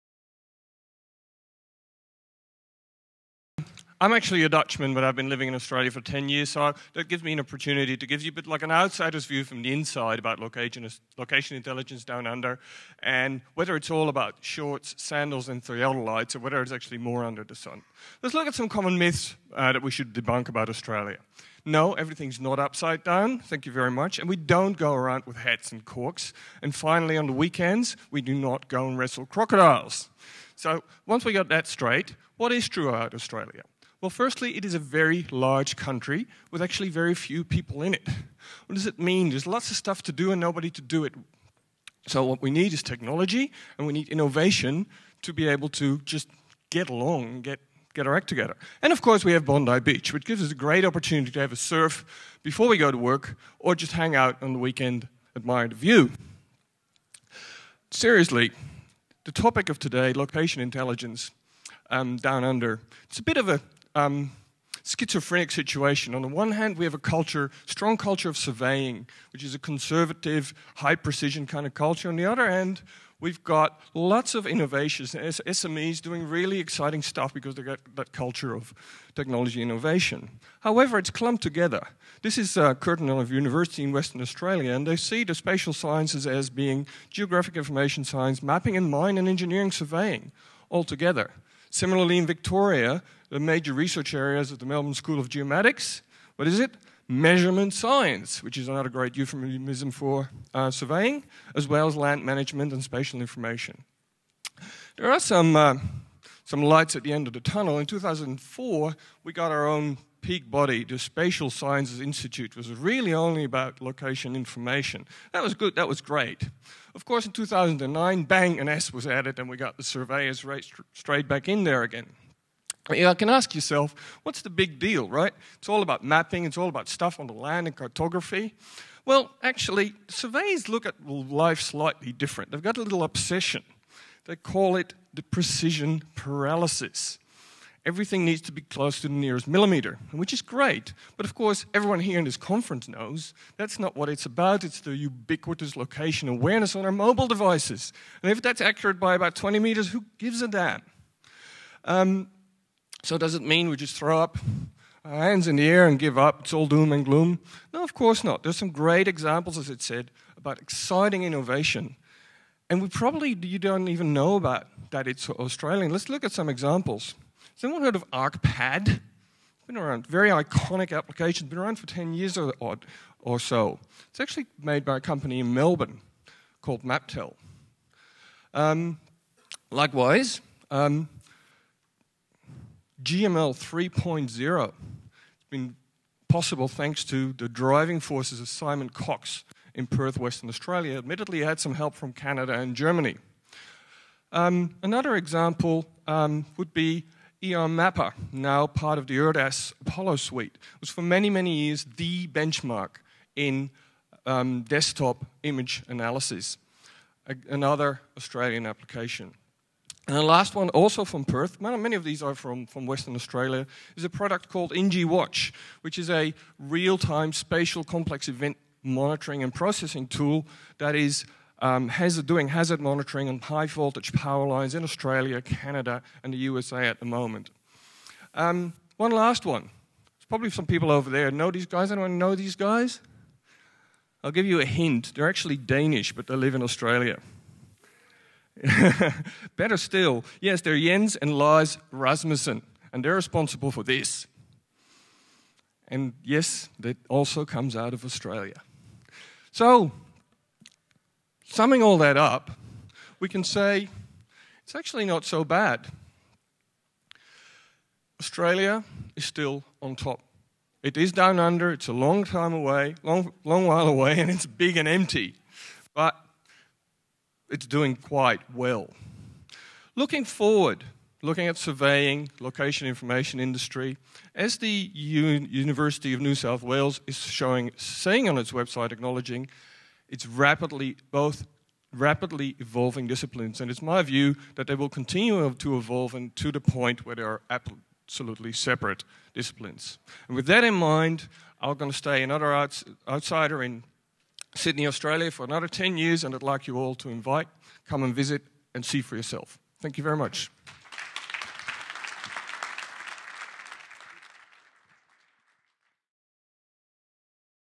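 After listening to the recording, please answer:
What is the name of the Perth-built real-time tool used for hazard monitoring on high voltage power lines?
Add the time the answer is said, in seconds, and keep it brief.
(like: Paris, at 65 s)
NG Watch, at 214 s.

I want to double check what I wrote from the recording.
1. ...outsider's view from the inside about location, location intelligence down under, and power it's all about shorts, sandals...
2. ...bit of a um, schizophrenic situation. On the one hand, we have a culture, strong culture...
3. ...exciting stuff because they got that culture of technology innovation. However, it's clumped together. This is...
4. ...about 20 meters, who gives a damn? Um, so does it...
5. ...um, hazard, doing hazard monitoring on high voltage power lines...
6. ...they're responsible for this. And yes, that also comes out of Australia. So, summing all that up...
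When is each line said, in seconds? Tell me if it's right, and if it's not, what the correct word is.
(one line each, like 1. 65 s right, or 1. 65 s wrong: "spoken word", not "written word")
1. 8 s wrong: "whether", not "power"
2. 63 s right
3. 76 s right
4. 149 s right
5. 221 s right
6. 243 s right.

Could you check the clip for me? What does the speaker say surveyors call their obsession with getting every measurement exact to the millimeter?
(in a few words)
precision paralysis.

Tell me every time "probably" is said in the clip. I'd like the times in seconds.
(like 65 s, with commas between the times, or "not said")
162 s, 230 s.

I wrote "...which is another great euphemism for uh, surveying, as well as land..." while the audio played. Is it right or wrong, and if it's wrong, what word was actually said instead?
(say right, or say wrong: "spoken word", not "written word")
right.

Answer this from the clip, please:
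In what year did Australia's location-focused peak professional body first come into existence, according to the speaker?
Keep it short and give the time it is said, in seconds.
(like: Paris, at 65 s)
2004, at 107 s.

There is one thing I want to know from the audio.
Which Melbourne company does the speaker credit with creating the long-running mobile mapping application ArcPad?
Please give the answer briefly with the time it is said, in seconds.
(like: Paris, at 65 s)
MapTel, at 176 s.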